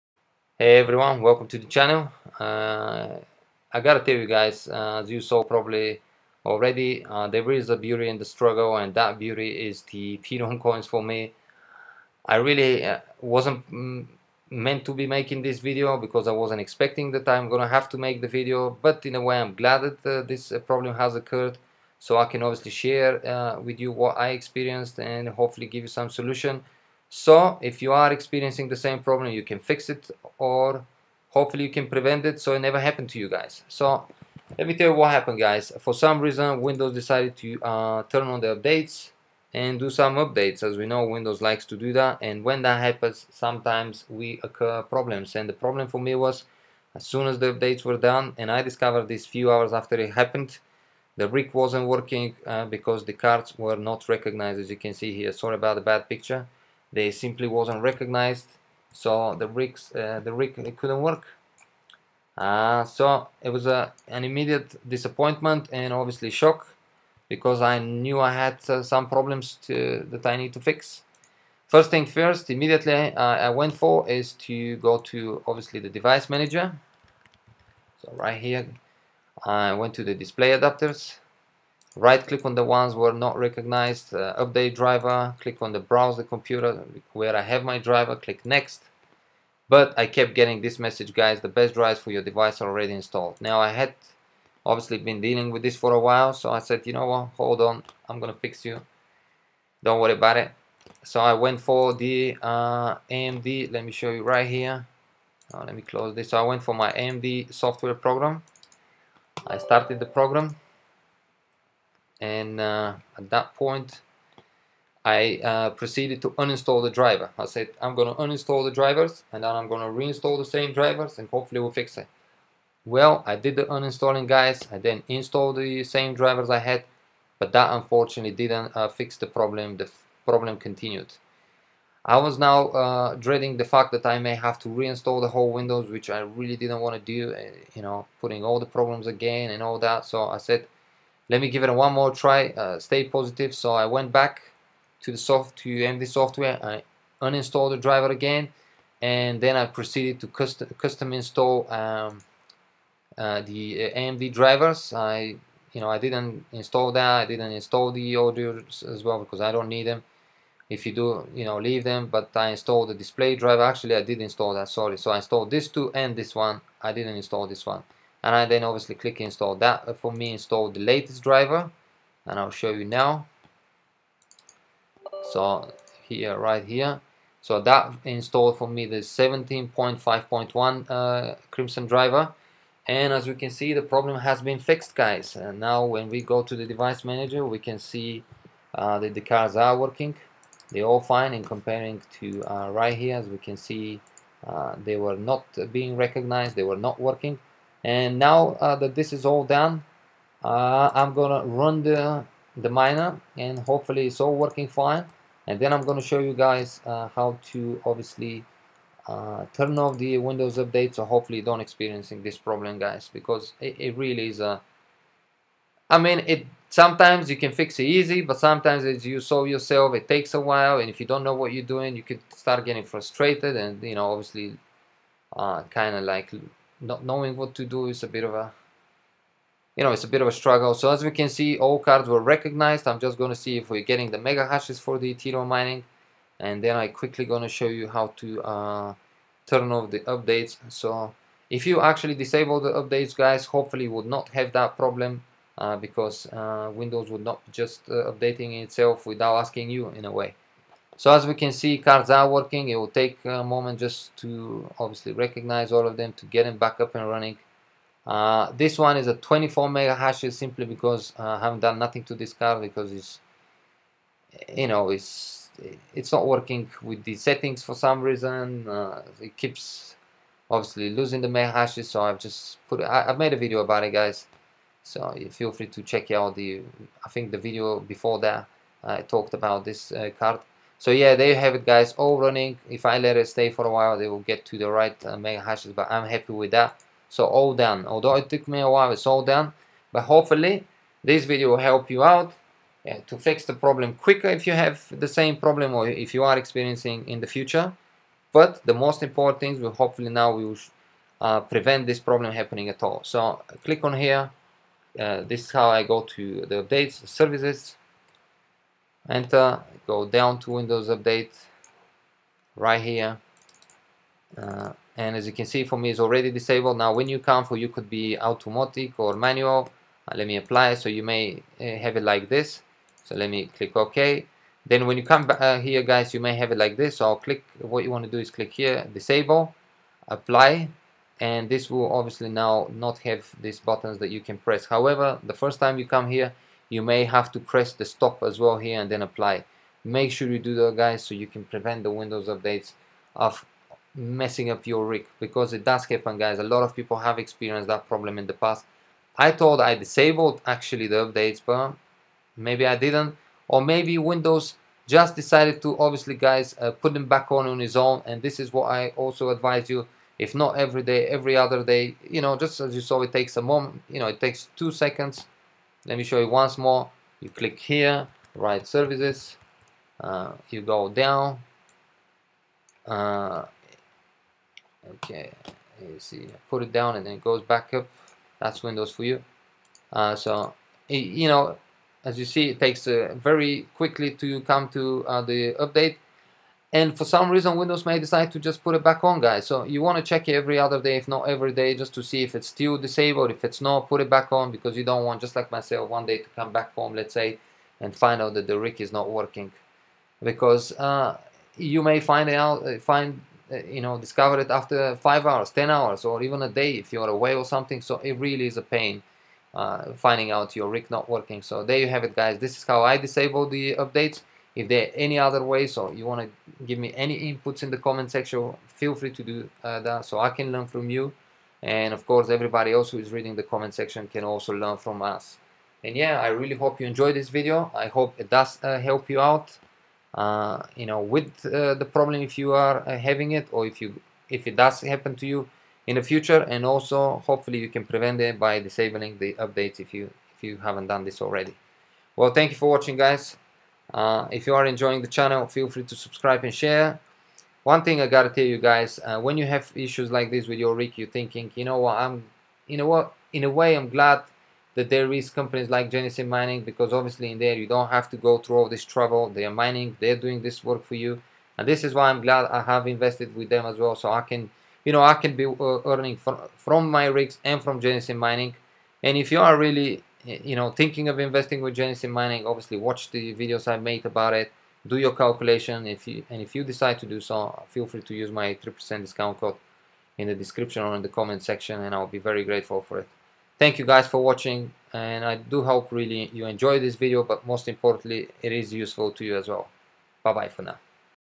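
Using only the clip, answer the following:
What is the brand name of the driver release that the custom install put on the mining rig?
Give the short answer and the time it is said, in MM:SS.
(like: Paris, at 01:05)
Crimson, at 03:01.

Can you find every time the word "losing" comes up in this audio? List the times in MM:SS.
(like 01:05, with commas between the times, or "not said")
04:30.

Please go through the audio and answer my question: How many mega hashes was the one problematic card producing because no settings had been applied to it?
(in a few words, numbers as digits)
24.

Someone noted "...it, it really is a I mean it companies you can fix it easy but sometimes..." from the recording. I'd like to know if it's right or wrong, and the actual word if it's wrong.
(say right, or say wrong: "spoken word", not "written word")
wrong: "sometimes", not "companies".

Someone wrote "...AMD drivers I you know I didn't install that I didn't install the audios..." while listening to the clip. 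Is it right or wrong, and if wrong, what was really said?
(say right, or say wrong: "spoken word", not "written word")
right.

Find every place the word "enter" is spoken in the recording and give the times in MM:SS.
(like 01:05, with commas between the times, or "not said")
05:09.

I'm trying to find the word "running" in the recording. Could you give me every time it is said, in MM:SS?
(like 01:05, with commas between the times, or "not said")
04:17, 04:42.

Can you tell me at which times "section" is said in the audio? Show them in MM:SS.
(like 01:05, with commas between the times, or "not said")
06:58, 07:03, 08:01.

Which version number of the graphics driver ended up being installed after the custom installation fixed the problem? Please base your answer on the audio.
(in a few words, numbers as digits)
17.5.1.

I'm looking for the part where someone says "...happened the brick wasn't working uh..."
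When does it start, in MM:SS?
00:50.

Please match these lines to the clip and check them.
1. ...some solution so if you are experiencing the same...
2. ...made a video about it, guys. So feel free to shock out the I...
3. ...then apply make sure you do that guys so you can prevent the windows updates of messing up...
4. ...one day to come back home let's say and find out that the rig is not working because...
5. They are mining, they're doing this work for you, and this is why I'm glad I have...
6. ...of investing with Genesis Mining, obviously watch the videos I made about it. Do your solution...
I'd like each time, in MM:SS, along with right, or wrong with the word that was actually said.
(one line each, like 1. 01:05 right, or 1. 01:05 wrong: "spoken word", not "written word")
1. 00:25 right
2. 04:33 wrong: "check", not "shock"
3. 05:38 right
4. 06:35 right
5. 07:39 right
6. 07:51 wrong: "calculation", not "solution".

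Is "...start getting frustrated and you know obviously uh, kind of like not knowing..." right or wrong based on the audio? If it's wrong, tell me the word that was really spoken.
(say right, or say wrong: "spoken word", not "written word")
right.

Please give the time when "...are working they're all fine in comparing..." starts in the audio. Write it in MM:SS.
03:09.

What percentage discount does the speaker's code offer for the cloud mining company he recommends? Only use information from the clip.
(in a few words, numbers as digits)
3%.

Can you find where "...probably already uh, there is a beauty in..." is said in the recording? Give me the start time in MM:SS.
00:05.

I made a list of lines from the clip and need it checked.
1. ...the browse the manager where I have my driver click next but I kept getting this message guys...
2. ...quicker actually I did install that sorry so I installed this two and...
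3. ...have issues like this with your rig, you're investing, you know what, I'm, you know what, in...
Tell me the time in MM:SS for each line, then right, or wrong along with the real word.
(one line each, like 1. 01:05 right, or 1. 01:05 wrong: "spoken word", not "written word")
1. 01:25 wrong: "computer", not "manager"
2. 02:43 wrong: "driver", not "quicker"
3. 07:29 wrong: "thinking", not "investing".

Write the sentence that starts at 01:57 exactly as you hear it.
I said I'm gonna uninstall the drivers and then I'm gonna reinstall the same drivers and hopefully we'll fix it.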